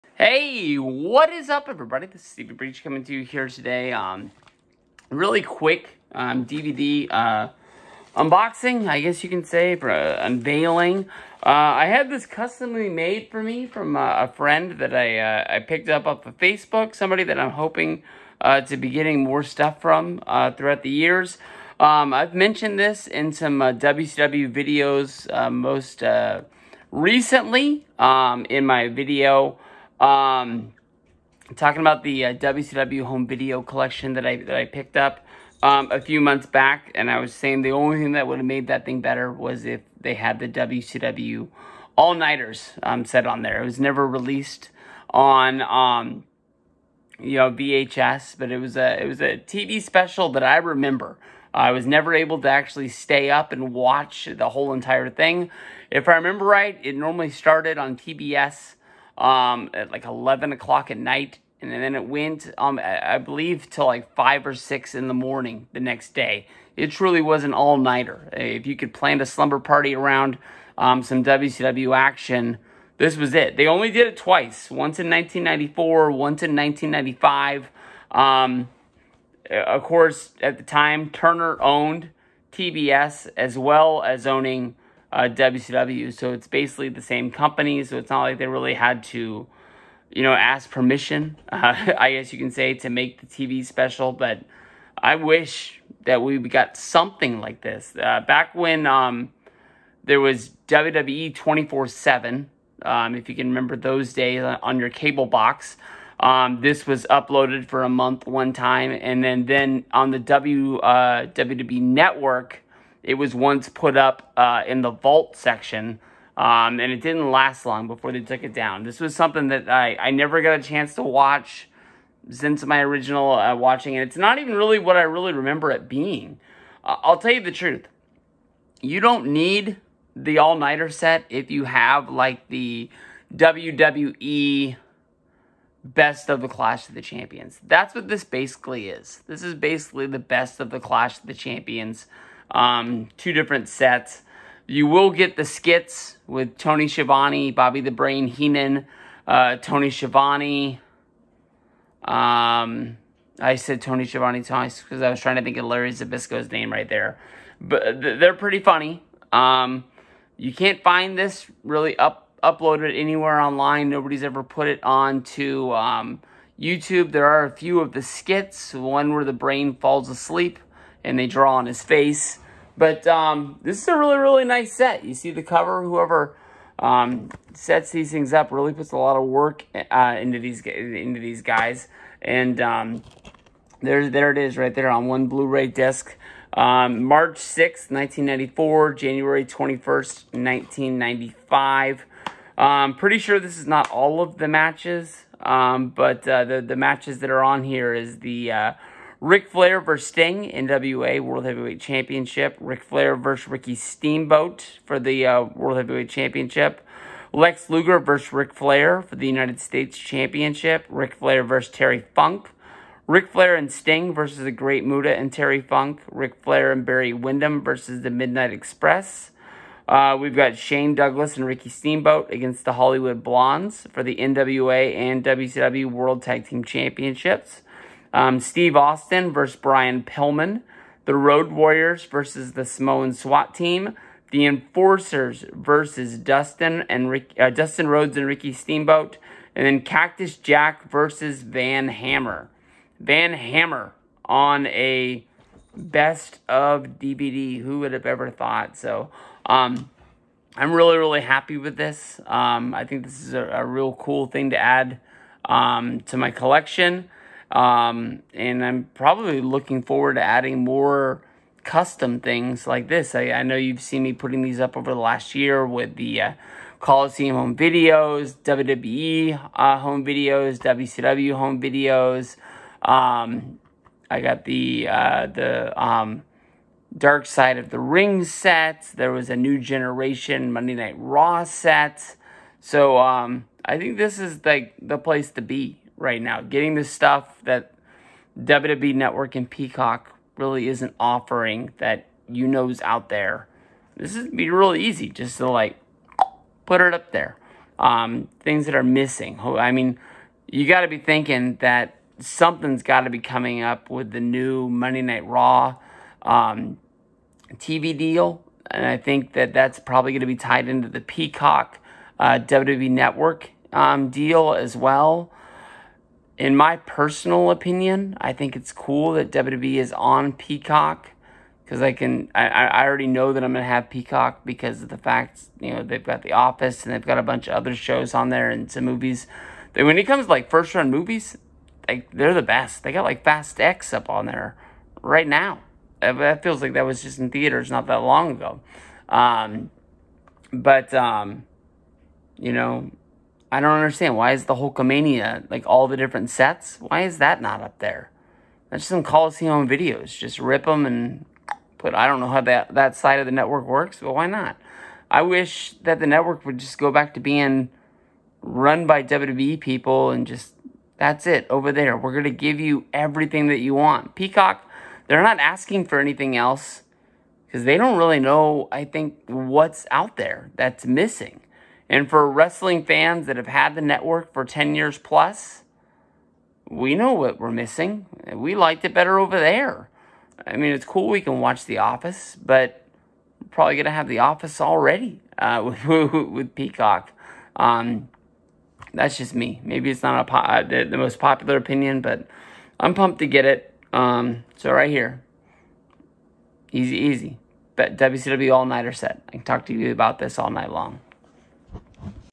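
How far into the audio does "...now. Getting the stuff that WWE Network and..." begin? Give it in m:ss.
4:46.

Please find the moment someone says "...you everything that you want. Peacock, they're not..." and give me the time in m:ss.
6:02.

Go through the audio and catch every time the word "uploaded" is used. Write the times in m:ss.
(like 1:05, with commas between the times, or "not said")
1:47, 2:42.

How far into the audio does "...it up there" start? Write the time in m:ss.
4:56.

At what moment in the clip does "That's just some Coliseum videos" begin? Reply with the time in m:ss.
5:48.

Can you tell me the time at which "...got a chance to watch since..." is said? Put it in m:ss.
2:00.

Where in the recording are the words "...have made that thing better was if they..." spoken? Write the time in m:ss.
0:38.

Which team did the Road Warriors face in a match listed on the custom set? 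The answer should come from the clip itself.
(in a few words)
the Samoan SWAT team.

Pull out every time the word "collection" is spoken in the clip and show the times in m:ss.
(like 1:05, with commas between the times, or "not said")
0:33, 4:16.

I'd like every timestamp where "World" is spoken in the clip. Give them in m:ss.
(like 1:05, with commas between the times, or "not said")
3:21, 3:25, 3:45.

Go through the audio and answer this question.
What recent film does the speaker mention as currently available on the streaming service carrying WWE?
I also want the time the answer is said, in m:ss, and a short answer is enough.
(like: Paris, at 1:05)
Fast X, at 5:33.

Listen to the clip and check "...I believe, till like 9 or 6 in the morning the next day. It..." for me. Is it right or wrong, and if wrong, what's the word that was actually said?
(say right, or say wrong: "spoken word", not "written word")
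wrong: "5", not "9".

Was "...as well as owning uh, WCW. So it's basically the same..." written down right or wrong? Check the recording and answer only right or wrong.
right.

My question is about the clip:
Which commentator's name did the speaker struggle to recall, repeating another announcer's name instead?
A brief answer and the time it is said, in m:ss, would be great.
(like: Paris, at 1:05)
Larry Zbyszko, at 2:35.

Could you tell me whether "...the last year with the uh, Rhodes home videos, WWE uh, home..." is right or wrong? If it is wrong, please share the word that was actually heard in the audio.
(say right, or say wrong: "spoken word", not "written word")
wrong: "Coliseum", not "Rhodes".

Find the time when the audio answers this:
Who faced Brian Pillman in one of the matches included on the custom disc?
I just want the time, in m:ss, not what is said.
3:48.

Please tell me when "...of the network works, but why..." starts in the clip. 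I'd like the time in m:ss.
5:53.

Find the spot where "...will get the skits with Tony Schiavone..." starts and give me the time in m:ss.
2:24.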